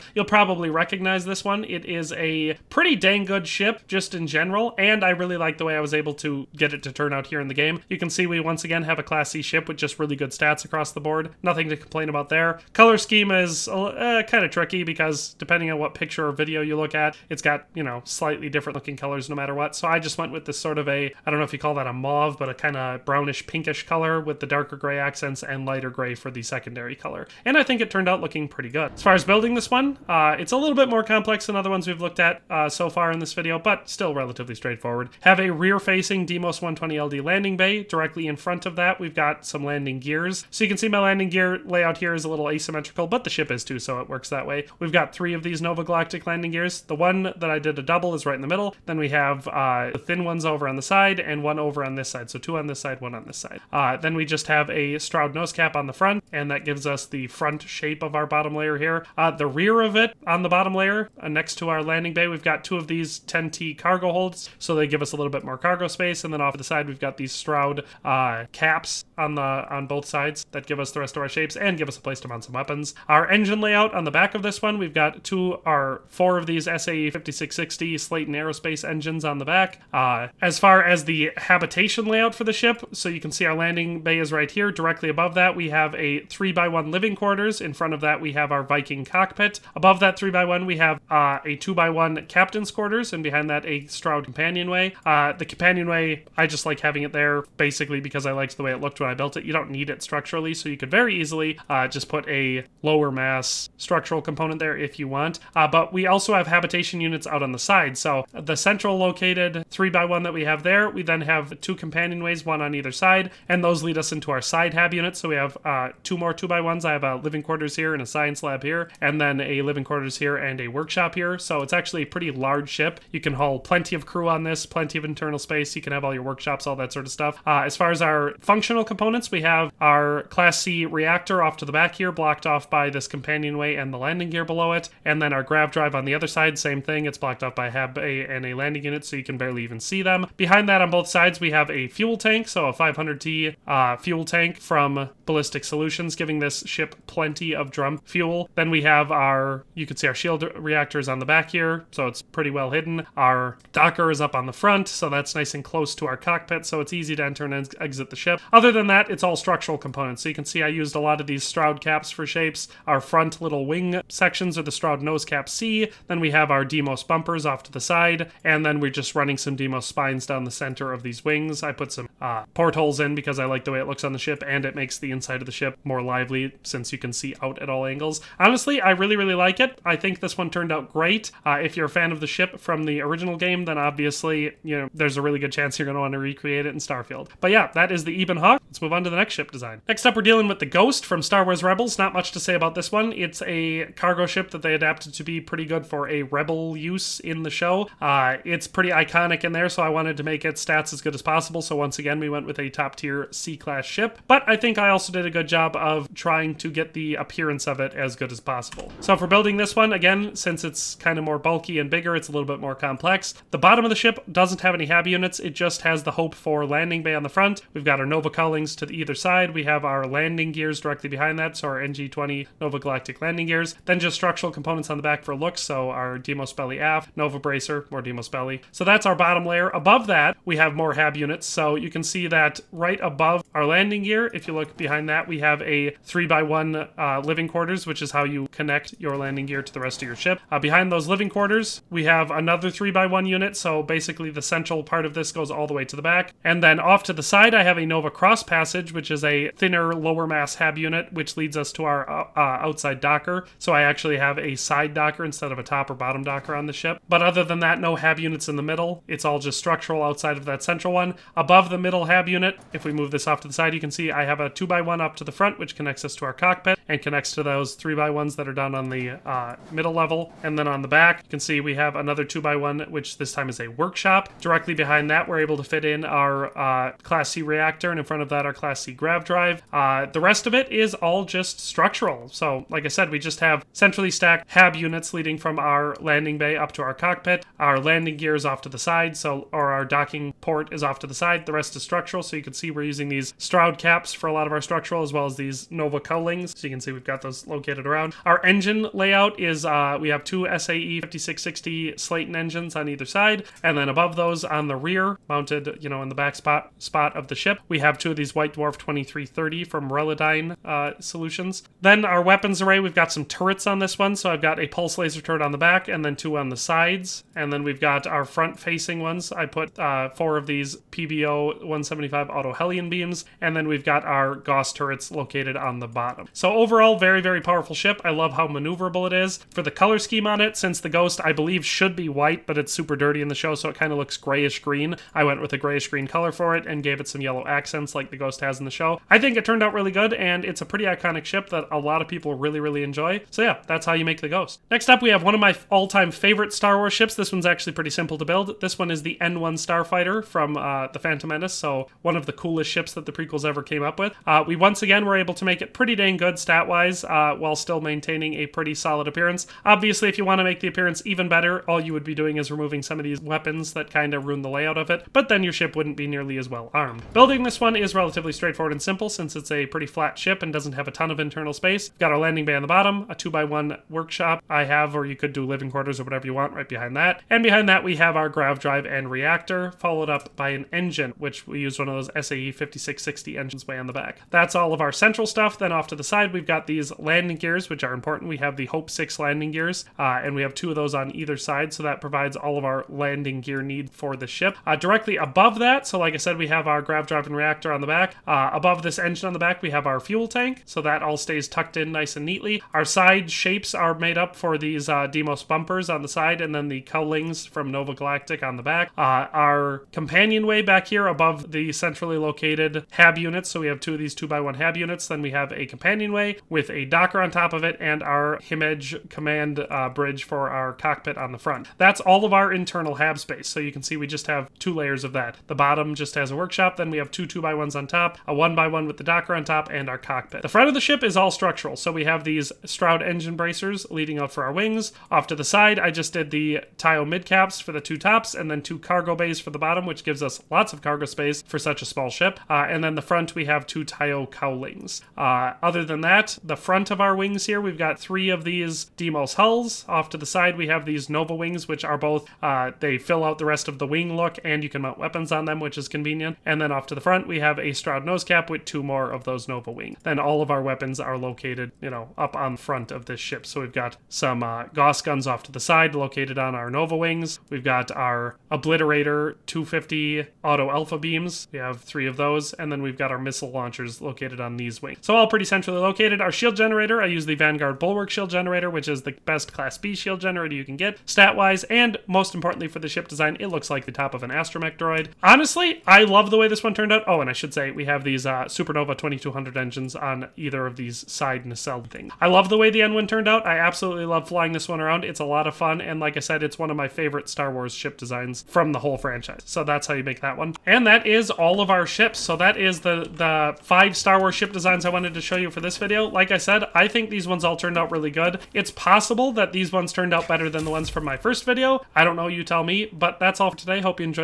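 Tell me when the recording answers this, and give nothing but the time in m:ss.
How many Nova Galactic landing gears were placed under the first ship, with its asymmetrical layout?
0:45.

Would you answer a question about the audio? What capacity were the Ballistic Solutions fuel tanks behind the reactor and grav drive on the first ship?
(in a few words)
500T.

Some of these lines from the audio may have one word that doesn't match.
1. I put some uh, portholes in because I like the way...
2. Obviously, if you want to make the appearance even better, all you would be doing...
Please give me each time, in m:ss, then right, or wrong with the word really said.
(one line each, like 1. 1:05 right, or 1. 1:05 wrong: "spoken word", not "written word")
1. 2:51 right
2. 5:59 right.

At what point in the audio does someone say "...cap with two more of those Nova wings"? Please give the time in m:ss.
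7:38.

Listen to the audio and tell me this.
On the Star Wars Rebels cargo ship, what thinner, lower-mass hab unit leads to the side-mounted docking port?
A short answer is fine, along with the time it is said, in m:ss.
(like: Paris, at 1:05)
Nova Cross Passage, at 4:07.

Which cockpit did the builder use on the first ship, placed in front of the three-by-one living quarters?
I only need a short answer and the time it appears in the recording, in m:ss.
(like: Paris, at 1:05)
Viking, at 1:28.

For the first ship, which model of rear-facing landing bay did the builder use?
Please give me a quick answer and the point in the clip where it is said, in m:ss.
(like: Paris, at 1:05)
Deimos 120LD, at 0:36.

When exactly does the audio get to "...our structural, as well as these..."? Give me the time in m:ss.
4:54.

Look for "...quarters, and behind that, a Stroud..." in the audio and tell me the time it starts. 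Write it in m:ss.
1:32.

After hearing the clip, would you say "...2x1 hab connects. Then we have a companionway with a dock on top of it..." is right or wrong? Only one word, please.
wrong.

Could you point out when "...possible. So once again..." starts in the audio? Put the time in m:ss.
3:21.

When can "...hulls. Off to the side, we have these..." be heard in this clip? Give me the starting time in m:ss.
7:29.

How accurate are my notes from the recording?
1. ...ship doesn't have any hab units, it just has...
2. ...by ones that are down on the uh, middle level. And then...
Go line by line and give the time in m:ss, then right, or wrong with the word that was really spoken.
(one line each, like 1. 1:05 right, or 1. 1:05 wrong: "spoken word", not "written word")
1. 3:33 right
2. 4:27 right.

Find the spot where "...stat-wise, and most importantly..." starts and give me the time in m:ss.
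8:01.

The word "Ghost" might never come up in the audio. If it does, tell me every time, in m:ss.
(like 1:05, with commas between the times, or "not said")
3:10, 5:30, 5:38, 5:44.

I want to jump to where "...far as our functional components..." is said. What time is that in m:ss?
2:07.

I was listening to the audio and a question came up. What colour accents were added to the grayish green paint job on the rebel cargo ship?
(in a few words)
Yellow.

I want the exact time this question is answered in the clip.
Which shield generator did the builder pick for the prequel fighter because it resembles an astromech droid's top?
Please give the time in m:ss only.
7:57.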